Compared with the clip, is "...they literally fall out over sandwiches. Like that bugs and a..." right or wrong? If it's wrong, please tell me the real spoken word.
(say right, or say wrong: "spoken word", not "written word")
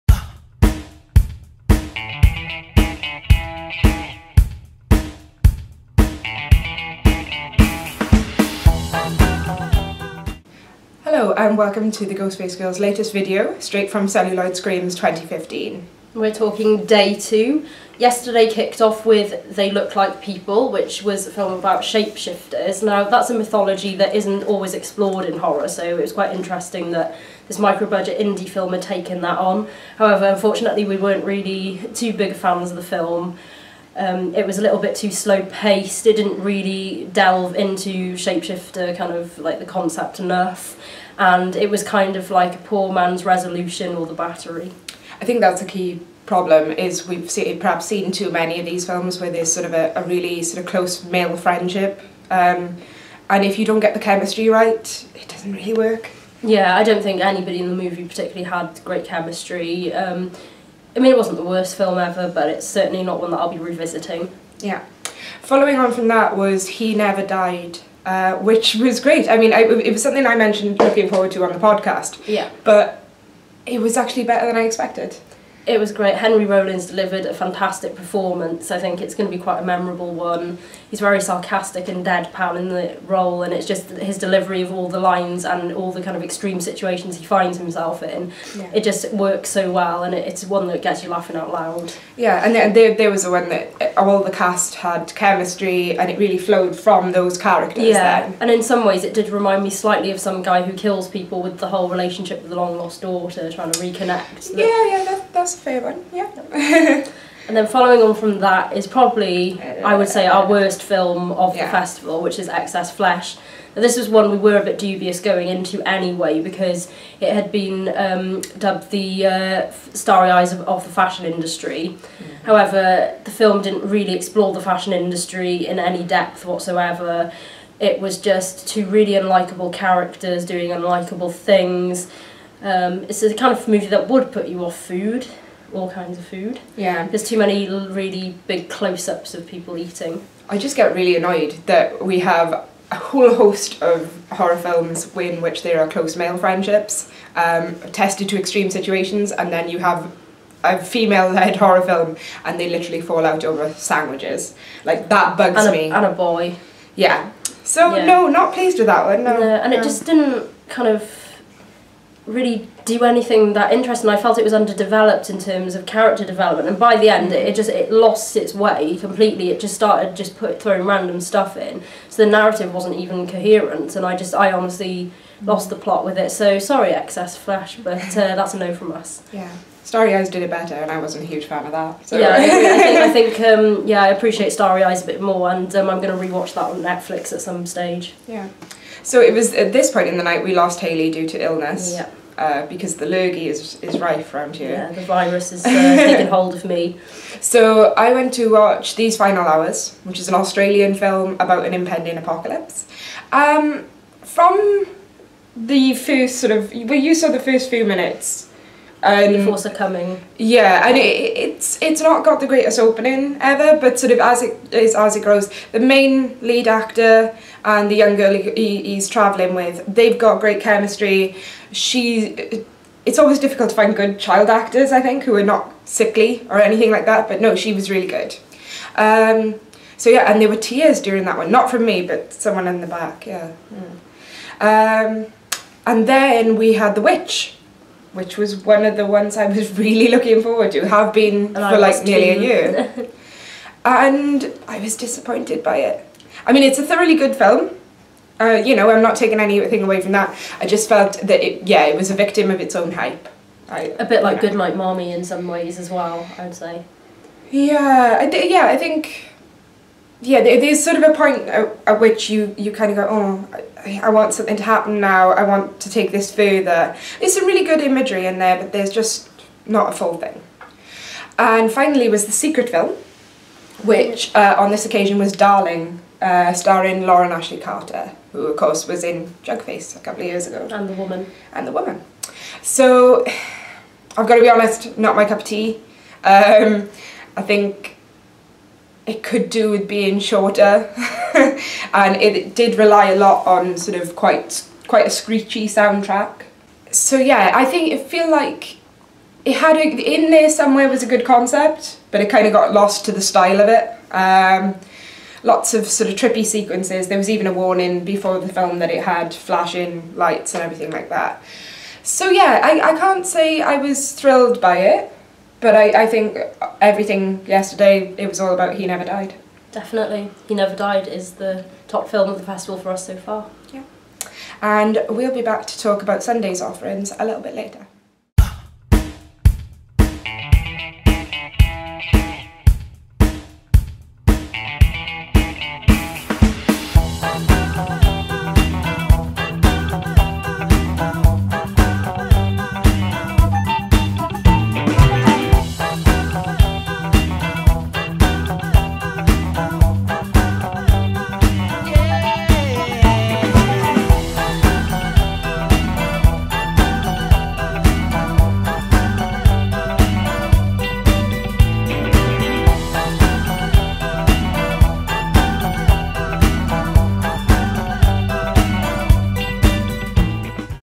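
right.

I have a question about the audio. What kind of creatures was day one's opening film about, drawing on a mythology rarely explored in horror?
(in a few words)
Shapeshifters.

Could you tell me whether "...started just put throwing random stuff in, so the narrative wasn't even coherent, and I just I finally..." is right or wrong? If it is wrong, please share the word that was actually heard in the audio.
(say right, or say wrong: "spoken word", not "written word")
wrong: "honestly", not "finally".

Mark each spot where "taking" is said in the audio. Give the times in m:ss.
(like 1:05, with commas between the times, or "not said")
3:15, 4:09.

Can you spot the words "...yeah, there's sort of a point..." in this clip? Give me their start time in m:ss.
4:20.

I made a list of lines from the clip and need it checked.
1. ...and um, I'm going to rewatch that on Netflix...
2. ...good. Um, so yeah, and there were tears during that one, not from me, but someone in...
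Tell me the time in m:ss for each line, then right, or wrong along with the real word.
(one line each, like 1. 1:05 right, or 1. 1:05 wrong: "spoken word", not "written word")
1. 3:05 right
2. 3:48 right.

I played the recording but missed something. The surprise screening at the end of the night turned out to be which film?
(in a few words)
Darling.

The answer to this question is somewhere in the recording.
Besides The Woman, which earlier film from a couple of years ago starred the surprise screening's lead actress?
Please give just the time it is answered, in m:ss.
4:39.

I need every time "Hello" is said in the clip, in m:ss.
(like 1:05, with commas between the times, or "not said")
0:11.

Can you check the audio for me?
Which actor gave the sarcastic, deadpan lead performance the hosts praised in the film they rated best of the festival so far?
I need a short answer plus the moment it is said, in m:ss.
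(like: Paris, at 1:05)
Henry Rollins, at 1:16.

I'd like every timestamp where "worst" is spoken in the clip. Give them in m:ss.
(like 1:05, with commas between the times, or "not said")
1:01, 1:50.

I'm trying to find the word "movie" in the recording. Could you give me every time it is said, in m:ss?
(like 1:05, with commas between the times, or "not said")
0:57, 2:13.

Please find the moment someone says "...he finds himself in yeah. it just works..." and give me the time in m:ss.
1:27.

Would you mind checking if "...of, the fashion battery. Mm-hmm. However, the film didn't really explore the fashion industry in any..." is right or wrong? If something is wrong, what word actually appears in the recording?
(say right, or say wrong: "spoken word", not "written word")
wrong: "industry", not "battery".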